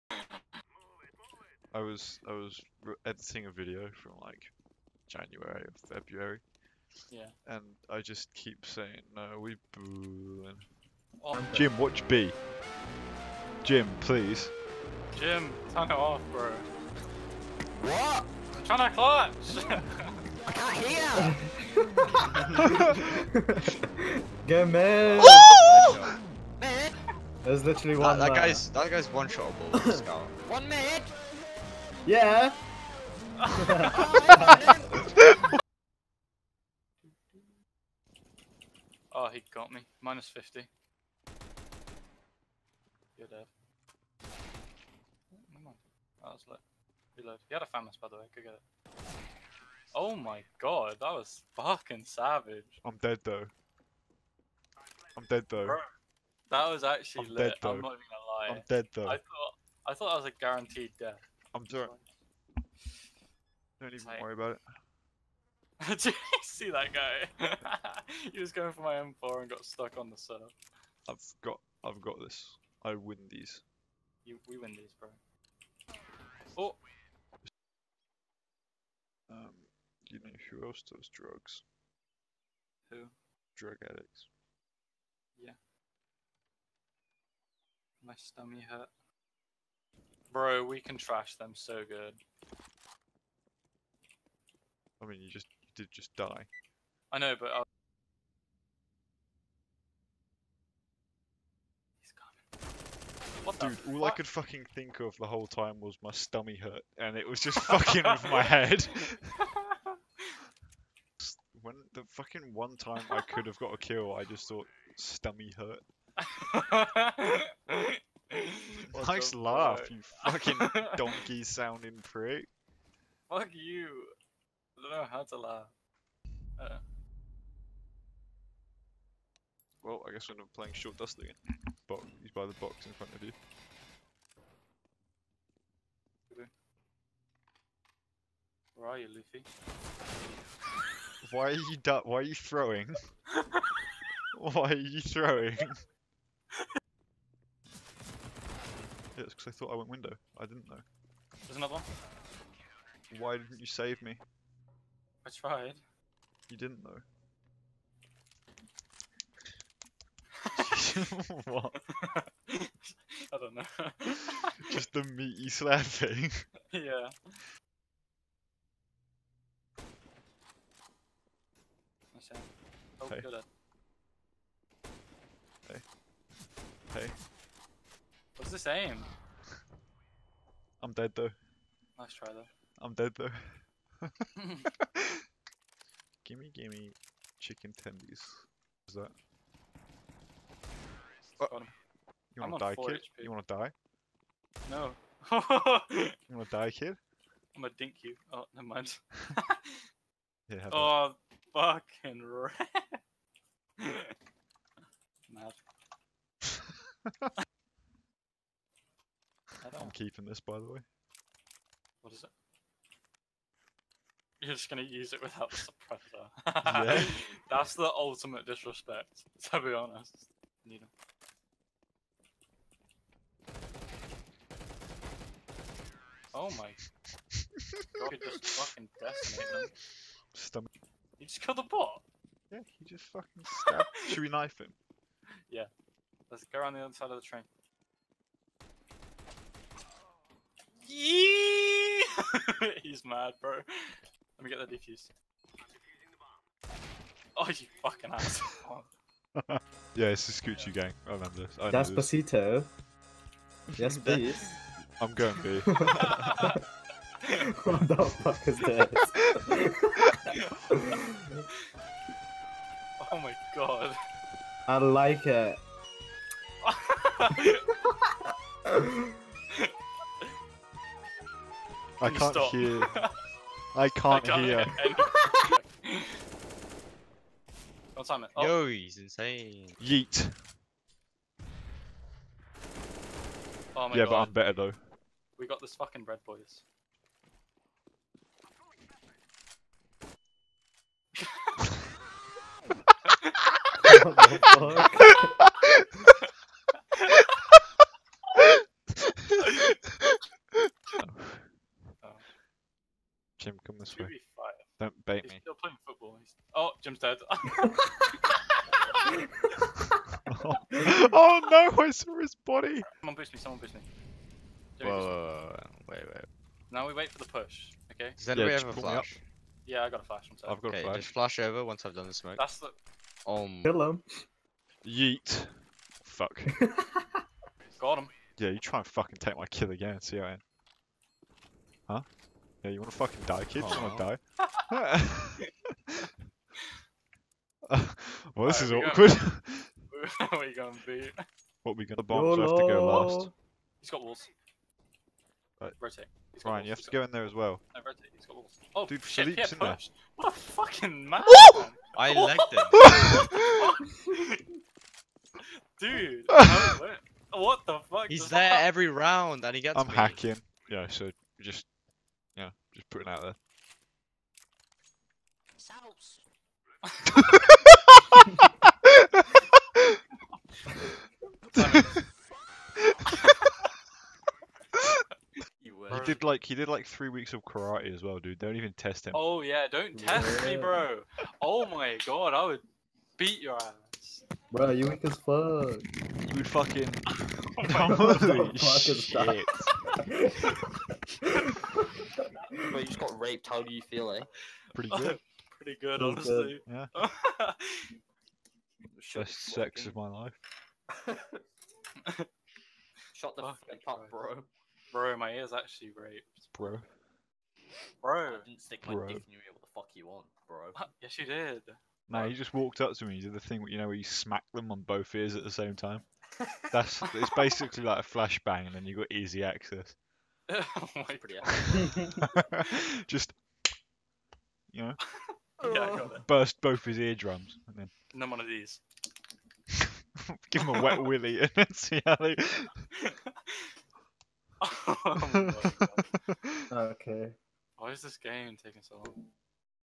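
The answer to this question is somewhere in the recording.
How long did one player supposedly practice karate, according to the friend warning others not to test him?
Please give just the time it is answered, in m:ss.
6:16.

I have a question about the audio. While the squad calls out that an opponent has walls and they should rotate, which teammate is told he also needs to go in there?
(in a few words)
Ryan.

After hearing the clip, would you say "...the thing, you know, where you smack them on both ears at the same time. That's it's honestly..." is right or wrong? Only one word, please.
wrong.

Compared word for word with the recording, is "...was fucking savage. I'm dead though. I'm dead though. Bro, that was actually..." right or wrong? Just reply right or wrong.
right.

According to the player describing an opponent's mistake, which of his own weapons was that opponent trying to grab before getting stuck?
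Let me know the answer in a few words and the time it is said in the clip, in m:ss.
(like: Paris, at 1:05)
M4, at 1:08.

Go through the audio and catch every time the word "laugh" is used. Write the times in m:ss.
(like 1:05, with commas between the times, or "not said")
1:59, 2:05.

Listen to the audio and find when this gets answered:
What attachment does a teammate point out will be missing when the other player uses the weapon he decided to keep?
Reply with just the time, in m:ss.
3:35.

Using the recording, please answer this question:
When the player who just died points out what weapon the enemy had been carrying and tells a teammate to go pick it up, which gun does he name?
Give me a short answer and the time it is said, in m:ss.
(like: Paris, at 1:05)
FAMAS, at 0:47.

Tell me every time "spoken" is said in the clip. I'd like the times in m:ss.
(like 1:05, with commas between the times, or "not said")
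not said.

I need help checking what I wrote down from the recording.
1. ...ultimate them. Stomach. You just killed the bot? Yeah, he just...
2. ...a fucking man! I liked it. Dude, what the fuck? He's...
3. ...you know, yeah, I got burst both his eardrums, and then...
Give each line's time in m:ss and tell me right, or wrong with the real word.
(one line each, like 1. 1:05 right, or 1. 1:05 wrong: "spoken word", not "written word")
1. 3:48 wrong: "decimate", not "ultimate"
2. 5:50 right
3. 7:04 right.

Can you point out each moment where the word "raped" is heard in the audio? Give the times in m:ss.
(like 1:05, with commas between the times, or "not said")
6:33, 6:45.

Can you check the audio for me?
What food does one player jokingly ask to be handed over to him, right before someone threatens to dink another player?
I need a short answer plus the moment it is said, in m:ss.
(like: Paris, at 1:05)
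chicken tendies, at 3:07.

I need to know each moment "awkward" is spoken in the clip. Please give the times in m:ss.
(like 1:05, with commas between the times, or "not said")
5:38.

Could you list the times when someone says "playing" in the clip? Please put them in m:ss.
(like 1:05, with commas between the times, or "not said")
2:10, 5:05.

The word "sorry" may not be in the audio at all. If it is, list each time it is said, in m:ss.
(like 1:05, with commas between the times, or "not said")
1:01, 5:20.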